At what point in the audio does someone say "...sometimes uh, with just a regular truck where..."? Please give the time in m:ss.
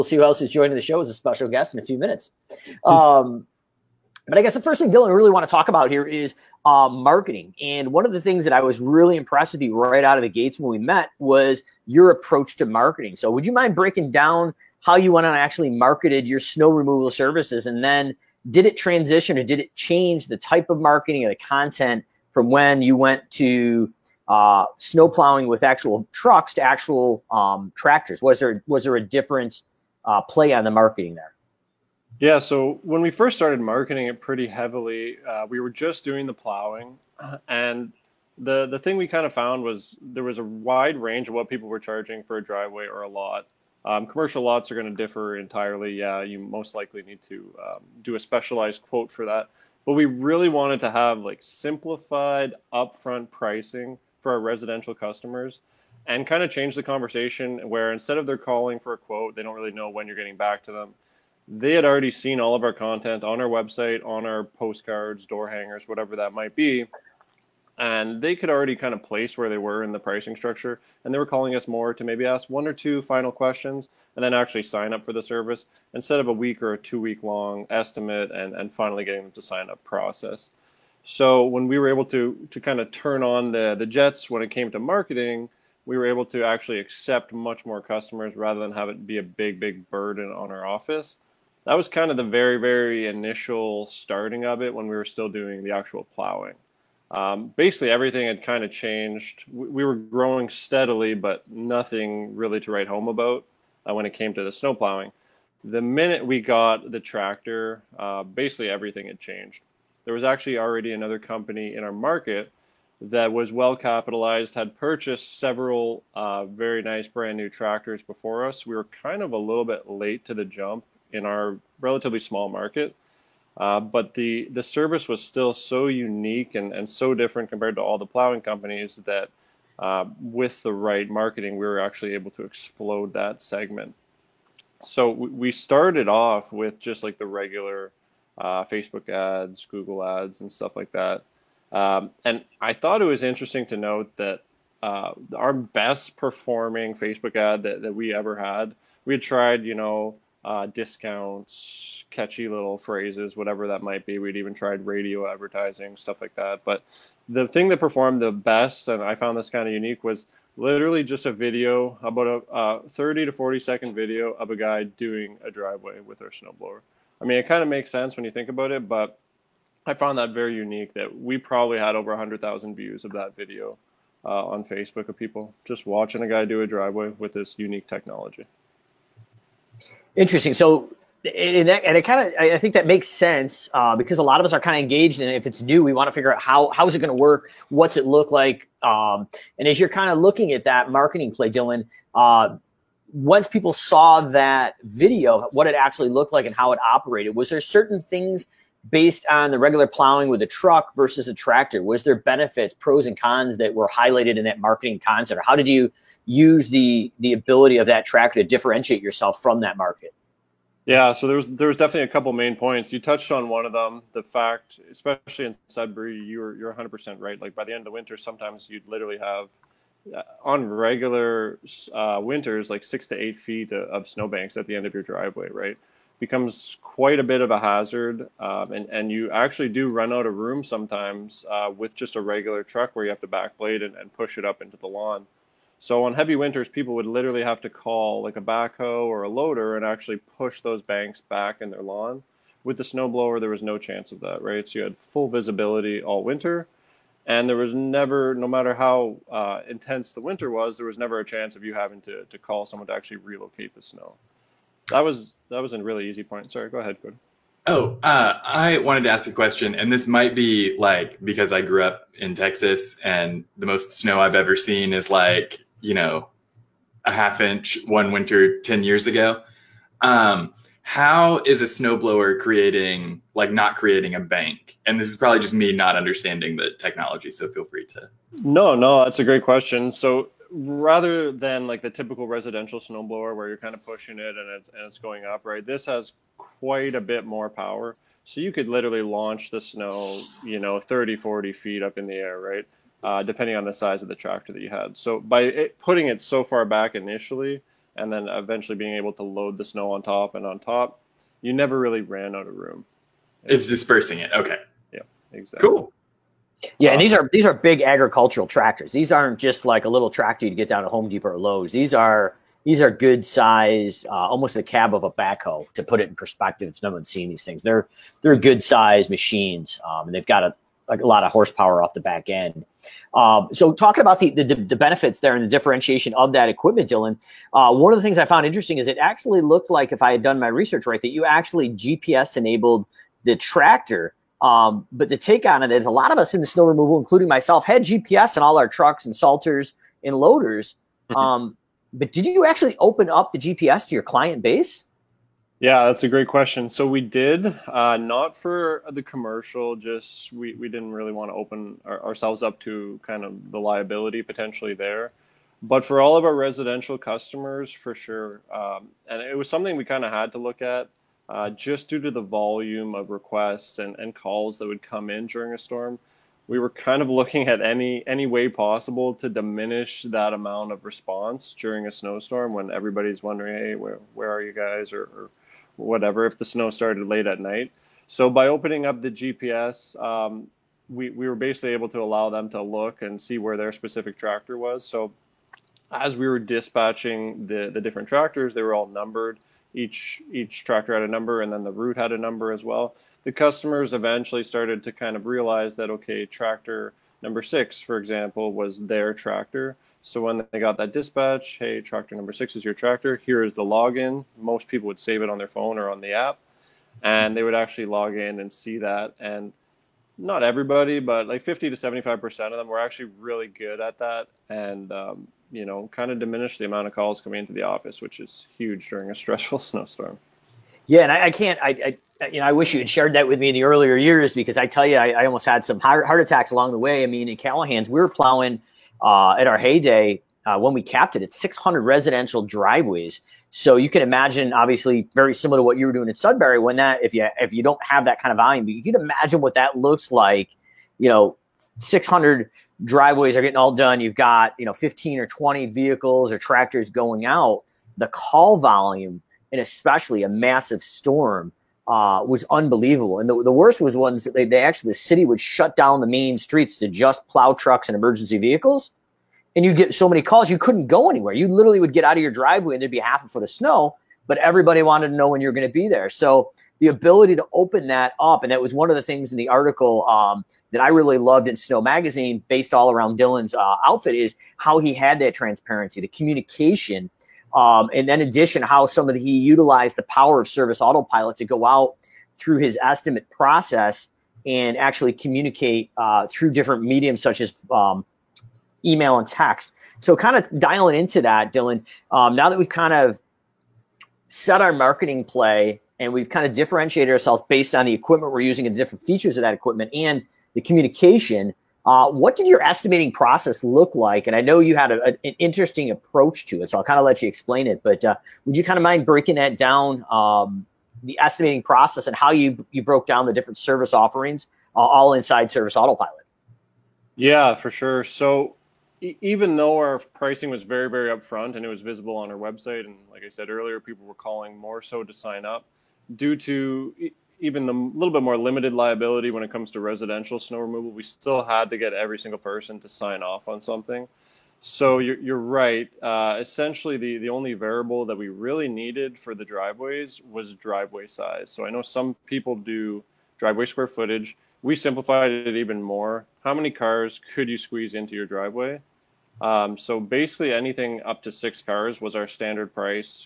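3:50.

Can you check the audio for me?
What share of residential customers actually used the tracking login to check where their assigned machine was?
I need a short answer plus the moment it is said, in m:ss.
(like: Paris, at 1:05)
50 to 75 percent, at 6:51.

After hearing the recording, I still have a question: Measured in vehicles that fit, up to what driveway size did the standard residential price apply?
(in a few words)
6 cars.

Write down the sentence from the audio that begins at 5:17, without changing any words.
They're they're good size machines, um, and they've got a like a lot of horsepower off the back end.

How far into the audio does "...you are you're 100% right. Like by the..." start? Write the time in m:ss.
3:36.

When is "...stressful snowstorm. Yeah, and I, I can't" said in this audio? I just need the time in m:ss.
6:59.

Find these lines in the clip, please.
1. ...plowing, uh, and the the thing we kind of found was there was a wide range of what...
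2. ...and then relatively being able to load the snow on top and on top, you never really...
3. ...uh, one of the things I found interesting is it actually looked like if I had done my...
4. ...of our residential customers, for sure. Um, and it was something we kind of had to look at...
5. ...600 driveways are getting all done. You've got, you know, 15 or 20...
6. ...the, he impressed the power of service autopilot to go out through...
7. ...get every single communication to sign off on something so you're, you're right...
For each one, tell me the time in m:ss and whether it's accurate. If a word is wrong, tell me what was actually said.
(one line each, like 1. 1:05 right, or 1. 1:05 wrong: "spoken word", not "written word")
1. 0:36 right
2. 4:57 wrong: "eventually", not "relatively"
3. 5:27 right
4. 5:56 right
5. 7:21 right
6. 7:59 wrong: "utilized", not "impressed"
7. 8:51 wrong: "person", not "communication".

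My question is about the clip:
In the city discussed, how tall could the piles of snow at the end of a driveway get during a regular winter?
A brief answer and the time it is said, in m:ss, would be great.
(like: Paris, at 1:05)
6 to 8 feet, at 3:42.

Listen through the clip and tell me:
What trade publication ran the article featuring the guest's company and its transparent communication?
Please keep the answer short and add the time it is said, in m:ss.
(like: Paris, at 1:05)
Snow Magazine, at 7:51.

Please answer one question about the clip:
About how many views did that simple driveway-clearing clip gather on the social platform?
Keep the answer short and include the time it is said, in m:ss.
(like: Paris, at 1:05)
Over 100,000, at 2:51.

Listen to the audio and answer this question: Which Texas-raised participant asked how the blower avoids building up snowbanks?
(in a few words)
Cody.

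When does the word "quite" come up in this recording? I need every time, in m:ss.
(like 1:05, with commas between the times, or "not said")
3:46, 4:46.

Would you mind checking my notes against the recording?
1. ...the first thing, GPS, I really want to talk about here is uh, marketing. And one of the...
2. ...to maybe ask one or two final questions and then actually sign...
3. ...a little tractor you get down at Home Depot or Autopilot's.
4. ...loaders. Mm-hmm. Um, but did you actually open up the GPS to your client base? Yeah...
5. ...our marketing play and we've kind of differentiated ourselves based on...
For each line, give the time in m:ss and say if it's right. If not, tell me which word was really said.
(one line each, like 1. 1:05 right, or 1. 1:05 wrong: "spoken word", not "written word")
1. 0:04 wrong: "Dillan", not "GPS"
2. 1:11 right
3. 5:09 wrong: "Lowe", not "Autopilot"
4. 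5:40 right
5. 8:14 right.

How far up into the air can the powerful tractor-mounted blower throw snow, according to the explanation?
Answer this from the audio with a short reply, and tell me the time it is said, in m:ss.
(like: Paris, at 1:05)
30 to 40 feet, at 4:50.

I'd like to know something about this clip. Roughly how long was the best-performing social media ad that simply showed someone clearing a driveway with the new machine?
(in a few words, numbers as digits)
30 to 40 seconds.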